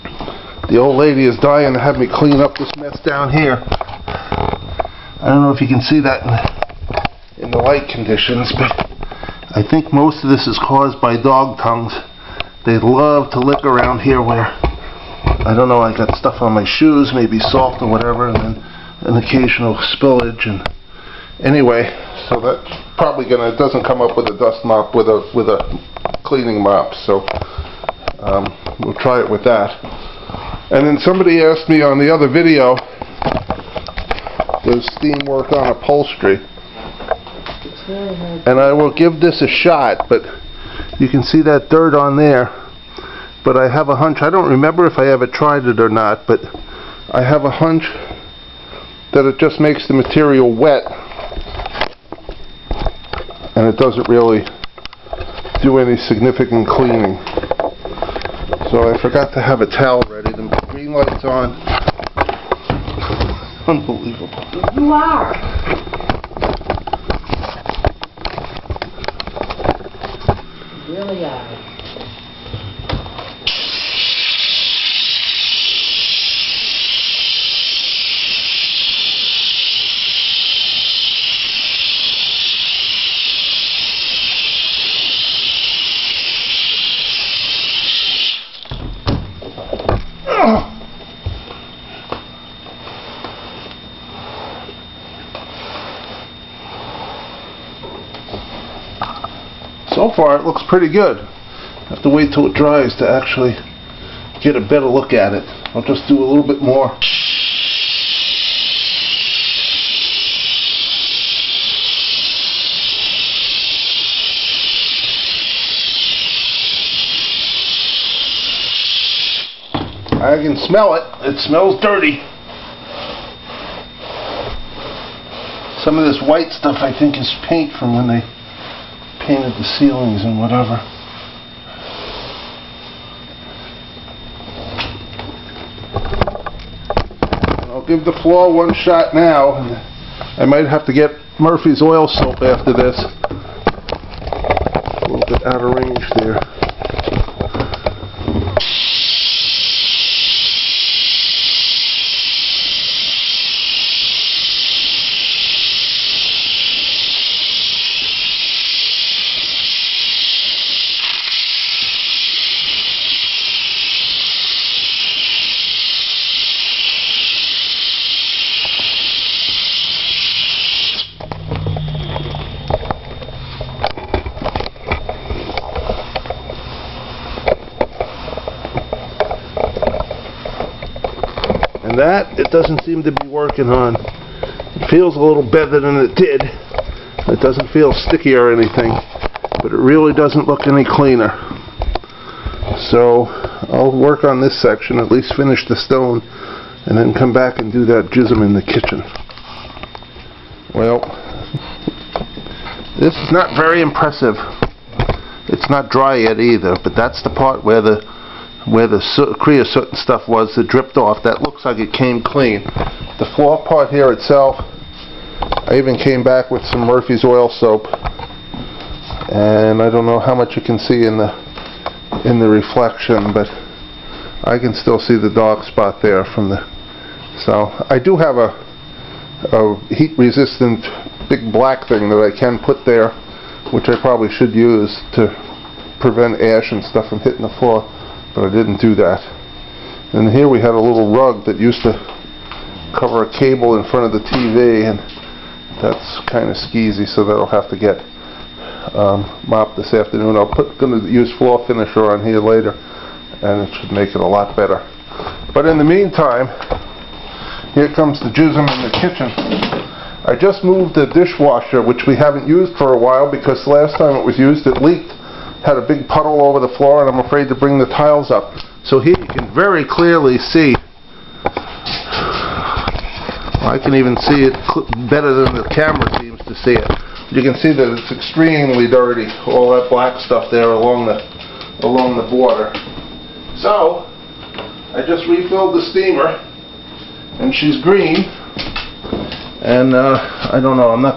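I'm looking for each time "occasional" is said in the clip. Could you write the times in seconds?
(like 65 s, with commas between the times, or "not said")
19 s.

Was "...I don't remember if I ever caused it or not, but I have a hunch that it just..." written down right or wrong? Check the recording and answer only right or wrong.
wrong.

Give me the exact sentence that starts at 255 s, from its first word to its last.
But in the meantime, here comes the jism in the kitchen.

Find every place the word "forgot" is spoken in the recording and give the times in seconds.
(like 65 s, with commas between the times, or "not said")
59 s.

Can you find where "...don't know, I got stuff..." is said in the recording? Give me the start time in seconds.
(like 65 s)
15 s.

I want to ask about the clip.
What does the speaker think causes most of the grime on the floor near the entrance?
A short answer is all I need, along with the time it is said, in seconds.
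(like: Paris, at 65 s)
dog tongues, at 11 s.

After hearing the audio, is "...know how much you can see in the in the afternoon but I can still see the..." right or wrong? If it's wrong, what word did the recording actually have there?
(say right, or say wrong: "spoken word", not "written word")
wrong: "reflection", not "afternoon".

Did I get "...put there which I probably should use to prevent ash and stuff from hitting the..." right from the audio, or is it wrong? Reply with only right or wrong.
right.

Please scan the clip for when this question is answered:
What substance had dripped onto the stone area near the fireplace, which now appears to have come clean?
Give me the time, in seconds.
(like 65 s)
209 s.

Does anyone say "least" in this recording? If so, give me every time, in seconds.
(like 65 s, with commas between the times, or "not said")
195 s.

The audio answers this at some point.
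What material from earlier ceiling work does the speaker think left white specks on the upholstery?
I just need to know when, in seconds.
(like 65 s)
127 s.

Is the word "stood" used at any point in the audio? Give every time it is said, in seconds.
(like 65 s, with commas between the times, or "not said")
not said.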